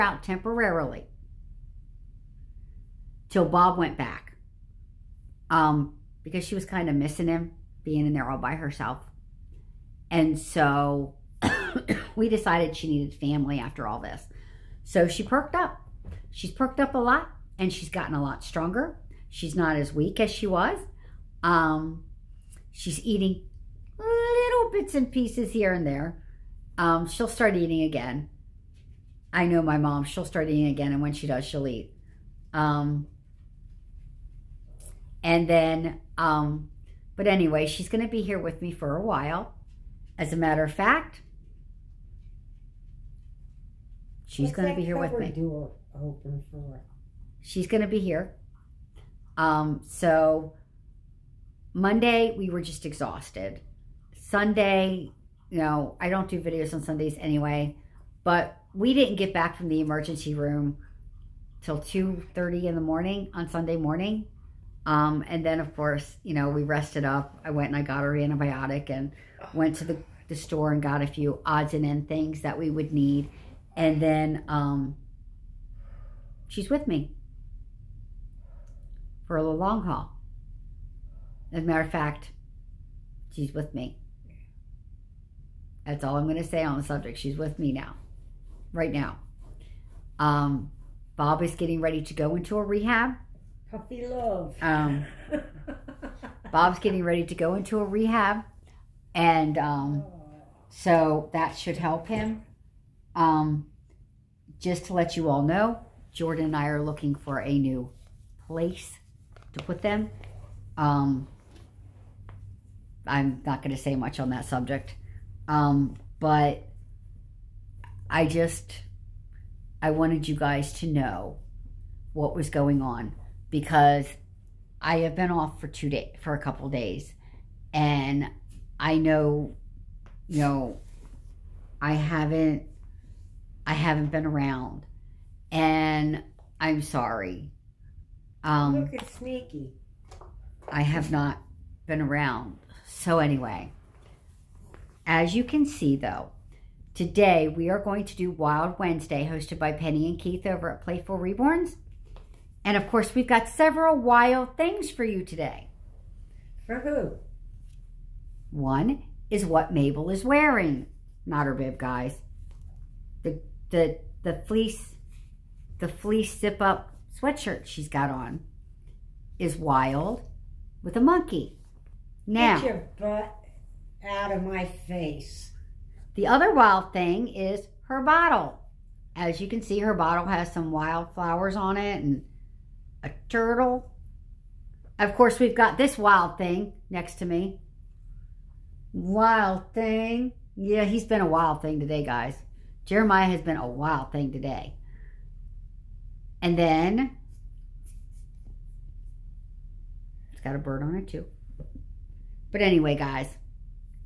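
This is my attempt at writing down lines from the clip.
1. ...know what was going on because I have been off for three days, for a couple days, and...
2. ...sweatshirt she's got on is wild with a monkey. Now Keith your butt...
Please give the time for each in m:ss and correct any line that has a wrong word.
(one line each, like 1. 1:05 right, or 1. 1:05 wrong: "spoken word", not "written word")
1. 2:00 wrong: "two", not "three"
2. 2:47 wrong: "Get", not "Keith".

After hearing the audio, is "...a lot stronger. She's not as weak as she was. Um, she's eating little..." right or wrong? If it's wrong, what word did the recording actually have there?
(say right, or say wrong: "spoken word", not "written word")
right.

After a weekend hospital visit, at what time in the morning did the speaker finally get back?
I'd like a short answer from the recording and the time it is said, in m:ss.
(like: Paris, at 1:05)
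2:30, at 1:01.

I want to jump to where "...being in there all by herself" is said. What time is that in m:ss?
0:07.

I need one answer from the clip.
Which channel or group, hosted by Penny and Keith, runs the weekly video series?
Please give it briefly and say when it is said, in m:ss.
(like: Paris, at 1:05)
Playful Reborns, at 2:30.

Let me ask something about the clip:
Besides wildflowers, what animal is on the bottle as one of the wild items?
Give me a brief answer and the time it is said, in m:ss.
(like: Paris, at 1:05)
turtle, at 3:03.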